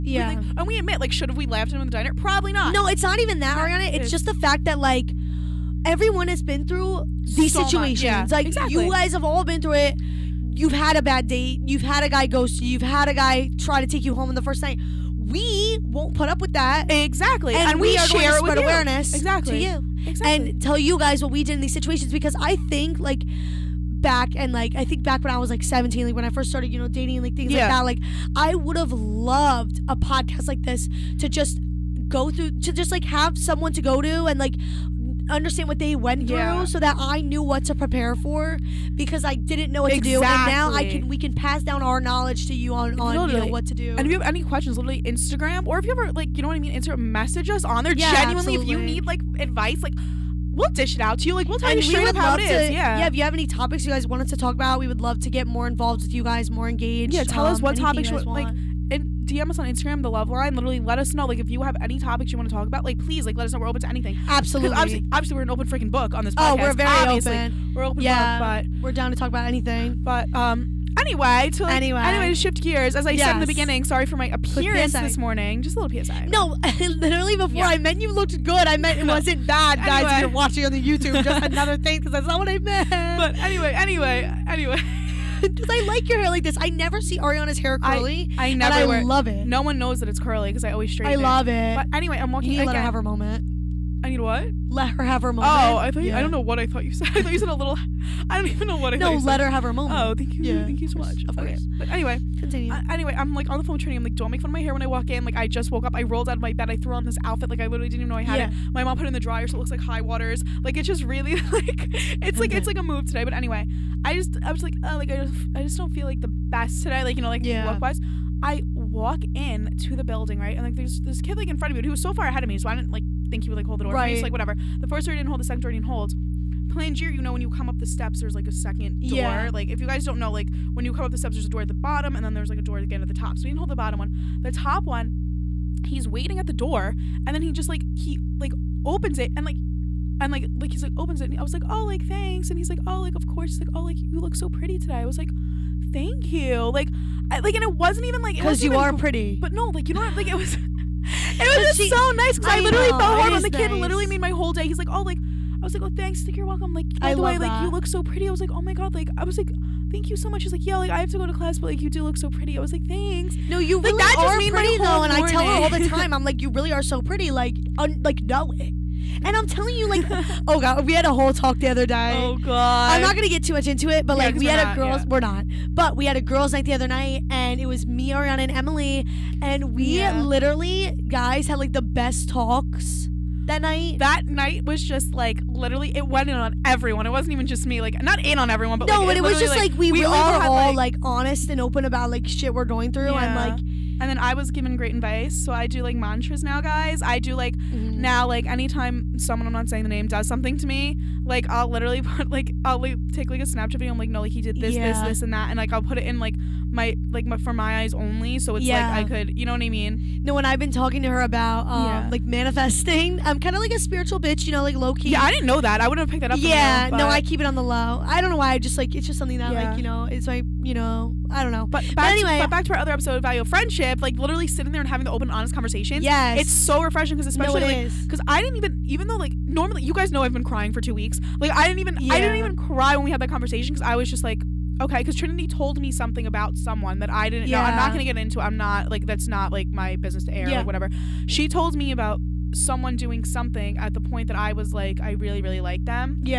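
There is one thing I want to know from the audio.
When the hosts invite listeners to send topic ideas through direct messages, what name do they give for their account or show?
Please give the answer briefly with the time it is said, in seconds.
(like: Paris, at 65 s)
The Love Line, at 60 s.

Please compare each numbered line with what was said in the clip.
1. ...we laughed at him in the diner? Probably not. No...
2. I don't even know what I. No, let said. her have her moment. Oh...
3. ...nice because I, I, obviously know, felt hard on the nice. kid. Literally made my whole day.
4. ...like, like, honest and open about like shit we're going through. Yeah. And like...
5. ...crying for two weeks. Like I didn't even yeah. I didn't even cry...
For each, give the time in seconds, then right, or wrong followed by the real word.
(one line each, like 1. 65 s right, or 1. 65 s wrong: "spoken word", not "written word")
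1. 1 s right
2. 98 s right
3. 152 s wrong: "literally", not "obviously"
4. 190 s right
5. 230 s right.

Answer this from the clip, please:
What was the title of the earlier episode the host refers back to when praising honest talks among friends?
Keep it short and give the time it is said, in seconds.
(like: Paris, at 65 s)
Value of Friendship, at 223 s.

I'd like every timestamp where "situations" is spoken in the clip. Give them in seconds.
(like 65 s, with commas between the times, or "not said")
7 s, 21 s.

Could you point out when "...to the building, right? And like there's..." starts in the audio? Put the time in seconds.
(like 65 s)
119 s.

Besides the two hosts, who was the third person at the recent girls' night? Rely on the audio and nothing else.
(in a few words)
Emily.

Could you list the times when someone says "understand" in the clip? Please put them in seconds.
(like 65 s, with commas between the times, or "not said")
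35 s.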